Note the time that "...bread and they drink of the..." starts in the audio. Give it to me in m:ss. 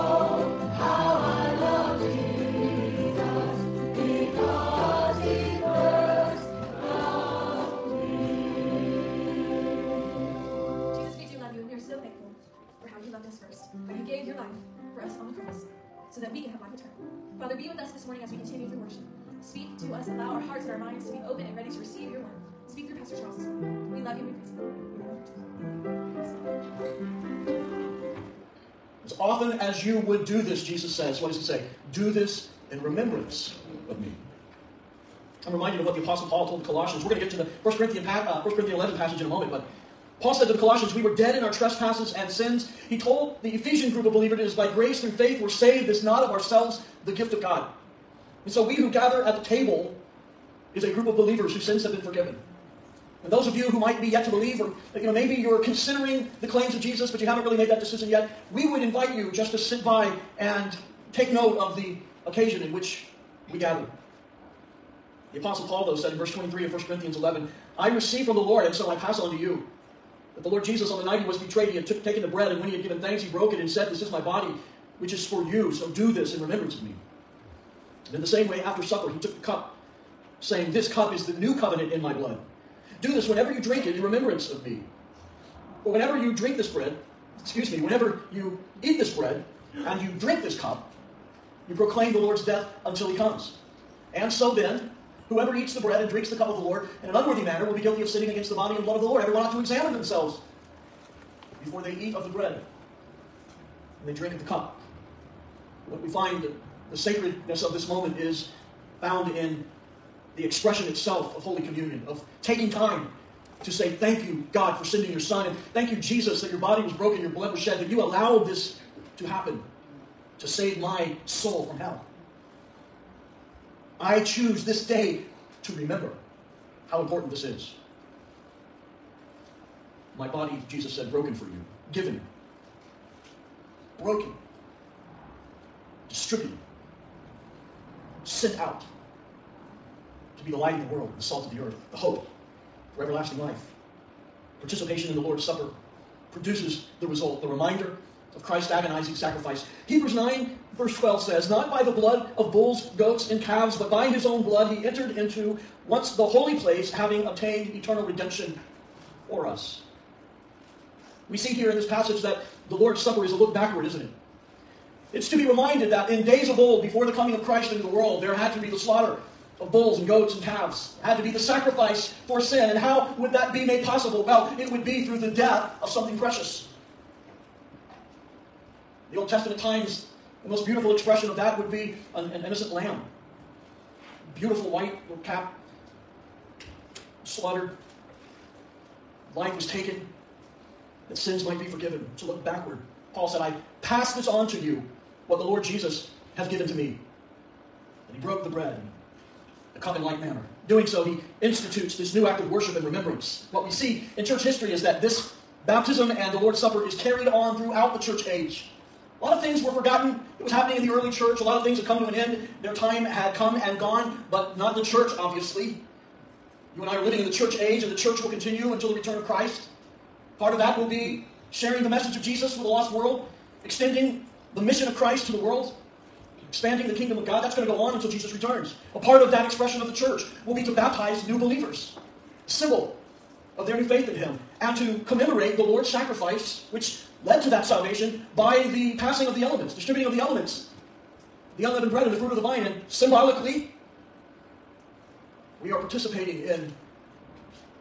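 1:42.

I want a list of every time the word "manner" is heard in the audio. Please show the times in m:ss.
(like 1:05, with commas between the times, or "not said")
1:37, 3:20.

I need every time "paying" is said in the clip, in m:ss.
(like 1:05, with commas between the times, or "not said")
not said.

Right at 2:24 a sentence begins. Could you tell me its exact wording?
Participation in the Lord's Supper produces the result, the reminder of Christ's agonizing sacrifice.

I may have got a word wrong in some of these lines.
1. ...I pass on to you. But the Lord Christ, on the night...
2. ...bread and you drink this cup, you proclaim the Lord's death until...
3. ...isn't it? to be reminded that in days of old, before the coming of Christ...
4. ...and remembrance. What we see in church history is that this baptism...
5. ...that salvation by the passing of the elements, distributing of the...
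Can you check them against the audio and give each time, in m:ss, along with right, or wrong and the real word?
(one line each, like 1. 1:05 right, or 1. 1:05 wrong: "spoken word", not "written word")
1. 1:08 wrong: "Jesus", not "Christ"
2. 1:29 right
3. 2:43 right
4. 3:22 right
5. 3:57 right.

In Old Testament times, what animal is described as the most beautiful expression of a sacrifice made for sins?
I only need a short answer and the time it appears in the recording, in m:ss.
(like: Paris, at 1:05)
an innocent lamb, at 3:02.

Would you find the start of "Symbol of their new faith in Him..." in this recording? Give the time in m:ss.
3:52.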